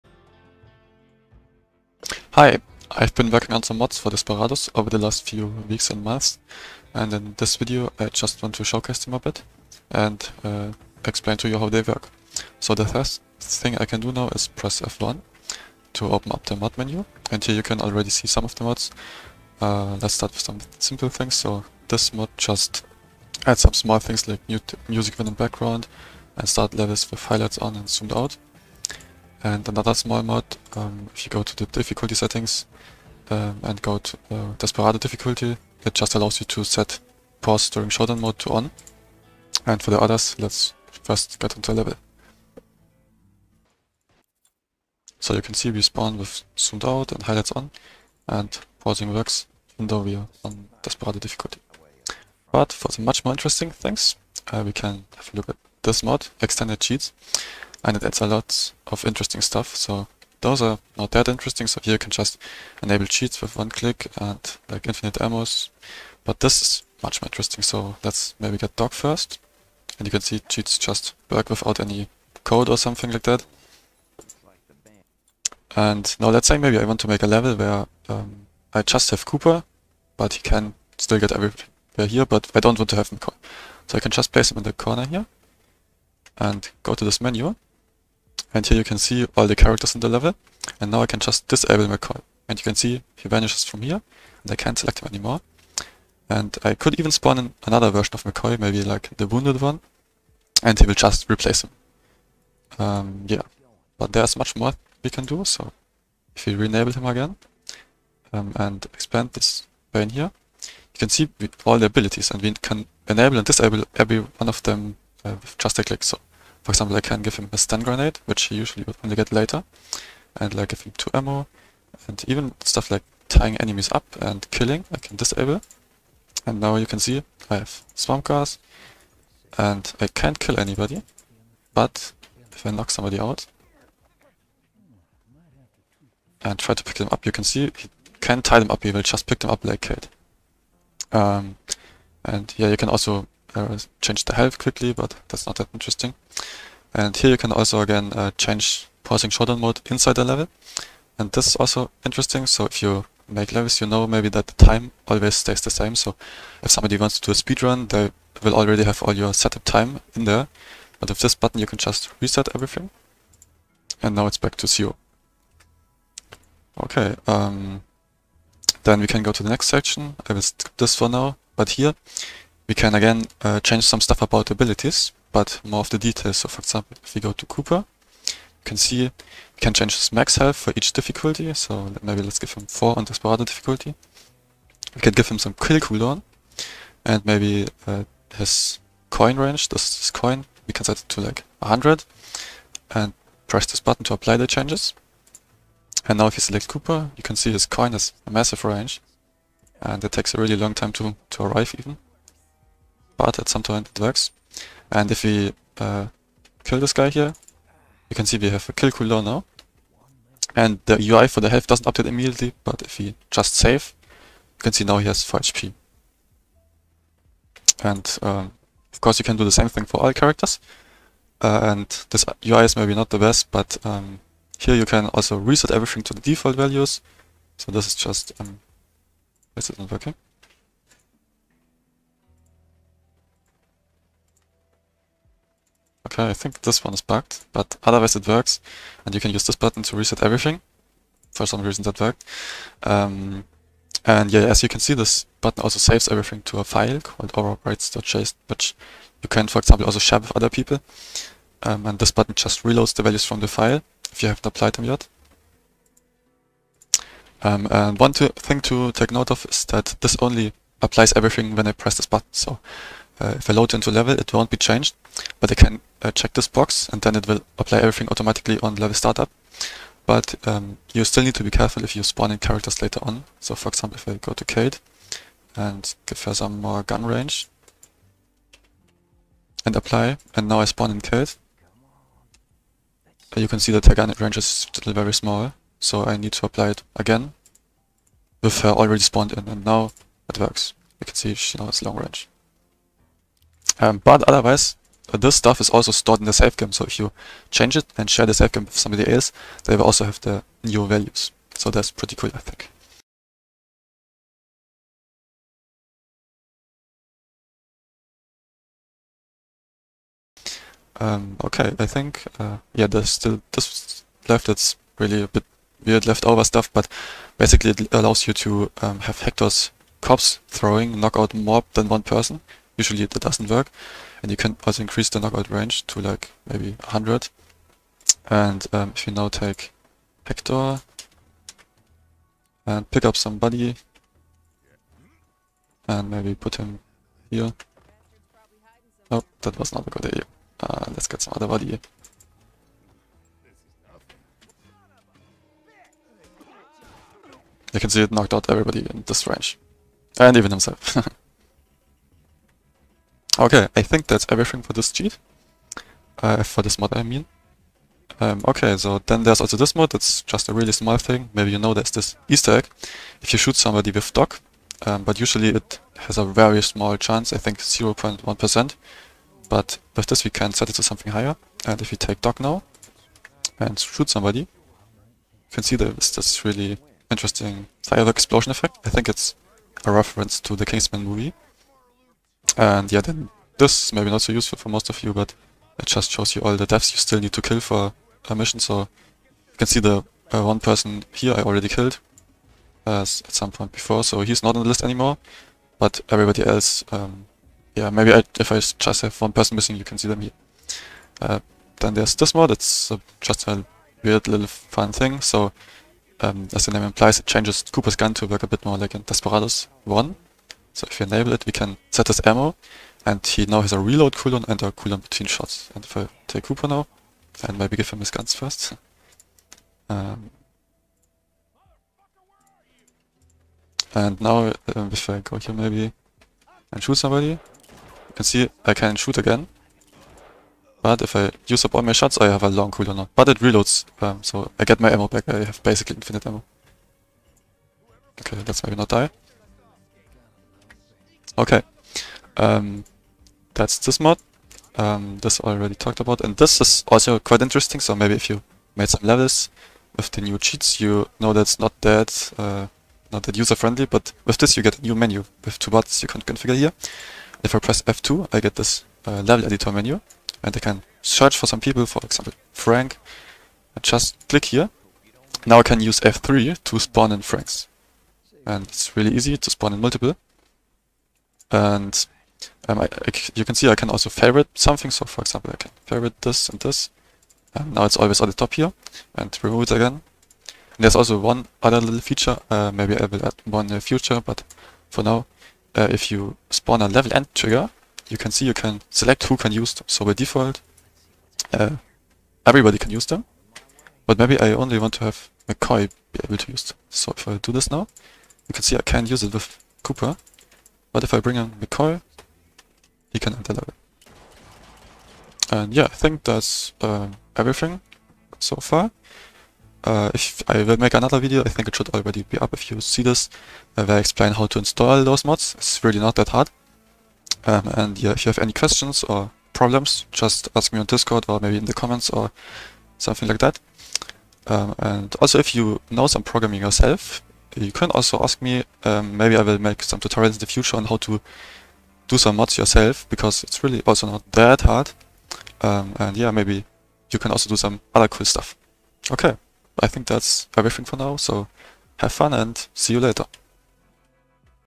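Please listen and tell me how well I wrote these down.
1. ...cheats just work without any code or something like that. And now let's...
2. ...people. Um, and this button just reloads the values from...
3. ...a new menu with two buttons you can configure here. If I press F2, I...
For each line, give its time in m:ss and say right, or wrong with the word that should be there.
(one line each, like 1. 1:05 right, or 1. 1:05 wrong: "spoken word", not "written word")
1. 1:10 right
2. 4:10 right
3. 7:34 right.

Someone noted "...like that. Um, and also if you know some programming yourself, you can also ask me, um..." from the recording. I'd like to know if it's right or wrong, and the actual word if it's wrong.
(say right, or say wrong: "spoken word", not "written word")
right.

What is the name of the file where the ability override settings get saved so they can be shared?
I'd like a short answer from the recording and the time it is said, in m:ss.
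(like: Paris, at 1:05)
overrides.json, at 4:07.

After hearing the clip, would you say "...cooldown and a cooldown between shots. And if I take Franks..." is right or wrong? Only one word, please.
wrong.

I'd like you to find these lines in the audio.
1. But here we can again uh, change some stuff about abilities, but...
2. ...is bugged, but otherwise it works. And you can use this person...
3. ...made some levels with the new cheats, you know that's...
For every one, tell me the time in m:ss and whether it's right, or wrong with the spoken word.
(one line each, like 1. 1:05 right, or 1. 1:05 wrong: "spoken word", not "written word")
1. 2:51 right
2. 3:56 wrong: "button", not "person"
3. 7:28 right.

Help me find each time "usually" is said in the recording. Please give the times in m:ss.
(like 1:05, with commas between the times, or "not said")
1:58, 5:22, 6:05.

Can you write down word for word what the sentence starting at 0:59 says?
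So those are not that interesting, so here you can just enable cheats with one click and like infinite ammos.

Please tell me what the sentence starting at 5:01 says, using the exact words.
So that's pretty cool, I think.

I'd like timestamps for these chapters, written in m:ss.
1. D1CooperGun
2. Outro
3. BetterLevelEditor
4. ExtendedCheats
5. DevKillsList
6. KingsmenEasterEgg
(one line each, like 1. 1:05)
1. 6:40
2. 8:24
3. 7:23
4. 0:58
5. 6:23
6. 5:58.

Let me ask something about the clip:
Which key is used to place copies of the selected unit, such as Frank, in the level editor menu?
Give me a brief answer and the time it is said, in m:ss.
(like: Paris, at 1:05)
F3, at 7:46.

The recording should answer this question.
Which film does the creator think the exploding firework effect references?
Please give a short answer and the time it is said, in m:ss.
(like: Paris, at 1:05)
Kingsman, at 6:20.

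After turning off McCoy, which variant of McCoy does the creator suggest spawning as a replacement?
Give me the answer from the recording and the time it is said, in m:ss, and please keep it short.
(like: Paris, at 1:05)
the wounded one, at 1:39.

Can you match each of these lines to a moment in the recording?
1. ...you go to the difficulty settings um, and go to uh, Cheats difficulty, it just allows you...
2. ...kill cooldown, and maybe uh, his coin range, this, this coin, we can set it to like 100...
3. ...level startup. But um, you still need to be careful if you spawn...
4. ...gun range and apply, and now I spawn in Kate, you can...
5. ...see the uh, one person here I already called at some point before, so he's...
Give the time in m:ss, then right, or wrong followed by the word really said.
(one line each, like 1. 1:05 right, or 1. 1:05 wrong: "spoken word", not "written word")
1. 0:31 wrong: "Desperado", not "Cheats"
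2. 3:05 right
3. 4:28 right
4. 4:36 right
5. 6:29 wrong: "killed", not "called".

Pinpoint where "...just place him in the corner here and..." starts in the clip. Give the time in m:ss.
1:24.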